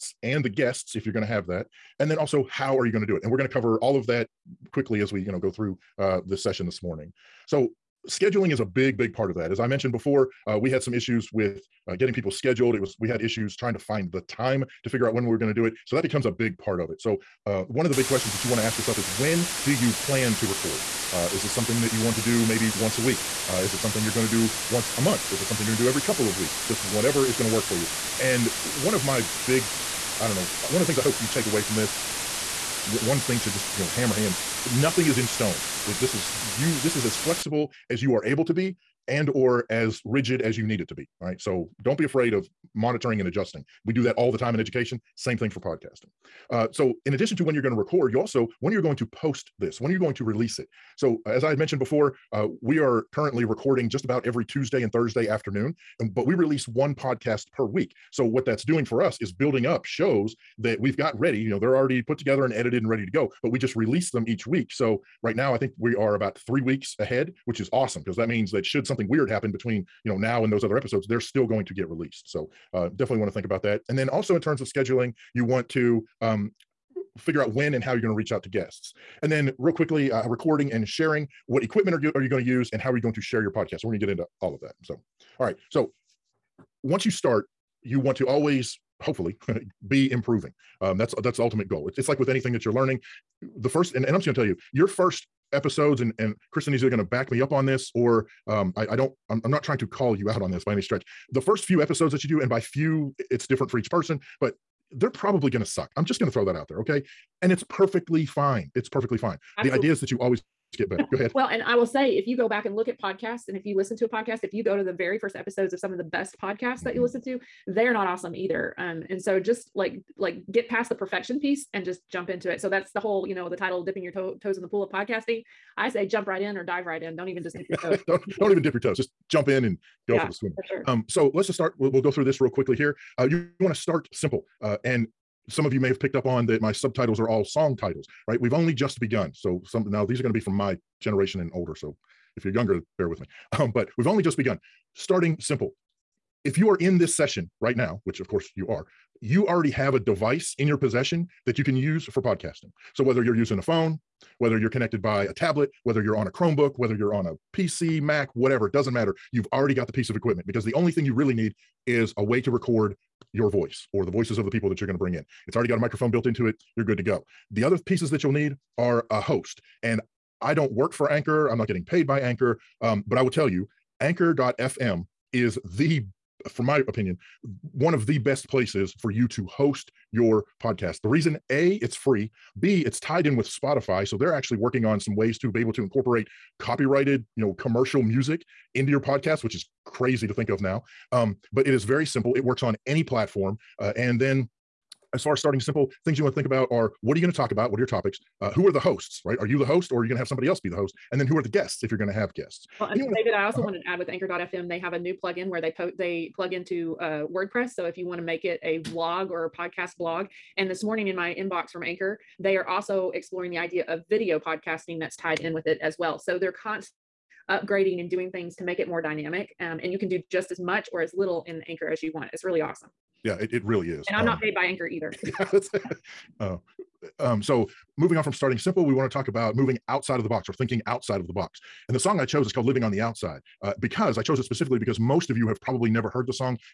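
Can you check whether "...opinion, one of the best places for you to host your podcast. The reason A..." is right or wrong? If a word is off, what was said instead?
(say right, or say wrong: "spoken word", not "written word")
right.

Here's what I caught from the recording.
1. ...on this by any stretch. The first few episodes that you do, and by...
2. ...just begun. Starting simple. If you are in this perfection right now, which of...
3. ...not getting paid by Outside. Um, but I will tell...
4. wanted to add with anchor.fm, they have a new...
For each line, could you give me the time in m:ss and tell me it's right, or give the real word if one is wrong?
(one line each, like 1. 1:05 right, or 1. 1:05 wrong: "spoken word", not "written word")
1. 1:40 right
2. 2:24 wrong: "session", not "perfection"
3. 2:51 wrong: "Anchor", not "Outside"
4. 3:23 right.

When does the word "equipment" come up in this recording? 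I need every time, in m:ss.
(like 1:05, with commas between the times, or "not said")
1:21, 2:40.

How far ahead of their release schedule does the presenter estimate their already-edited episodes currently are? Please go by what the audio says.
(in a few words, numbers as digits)
3 weeks.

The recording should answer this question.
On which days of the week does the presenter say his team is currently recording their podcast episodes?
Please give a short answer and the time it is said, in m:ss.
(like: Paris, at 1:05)
Tuesday and Thursday, at 0:54.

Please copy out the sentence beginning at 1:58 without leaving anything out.
Um, and so just like like get past the perfection piece and just jump into it.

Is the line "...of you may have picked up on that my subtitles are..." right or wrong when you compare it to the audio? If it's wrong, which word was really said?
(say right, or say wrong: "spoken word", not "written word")
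right.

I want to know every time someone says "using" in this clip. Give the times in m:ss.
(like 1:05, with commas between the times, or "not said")
2:33.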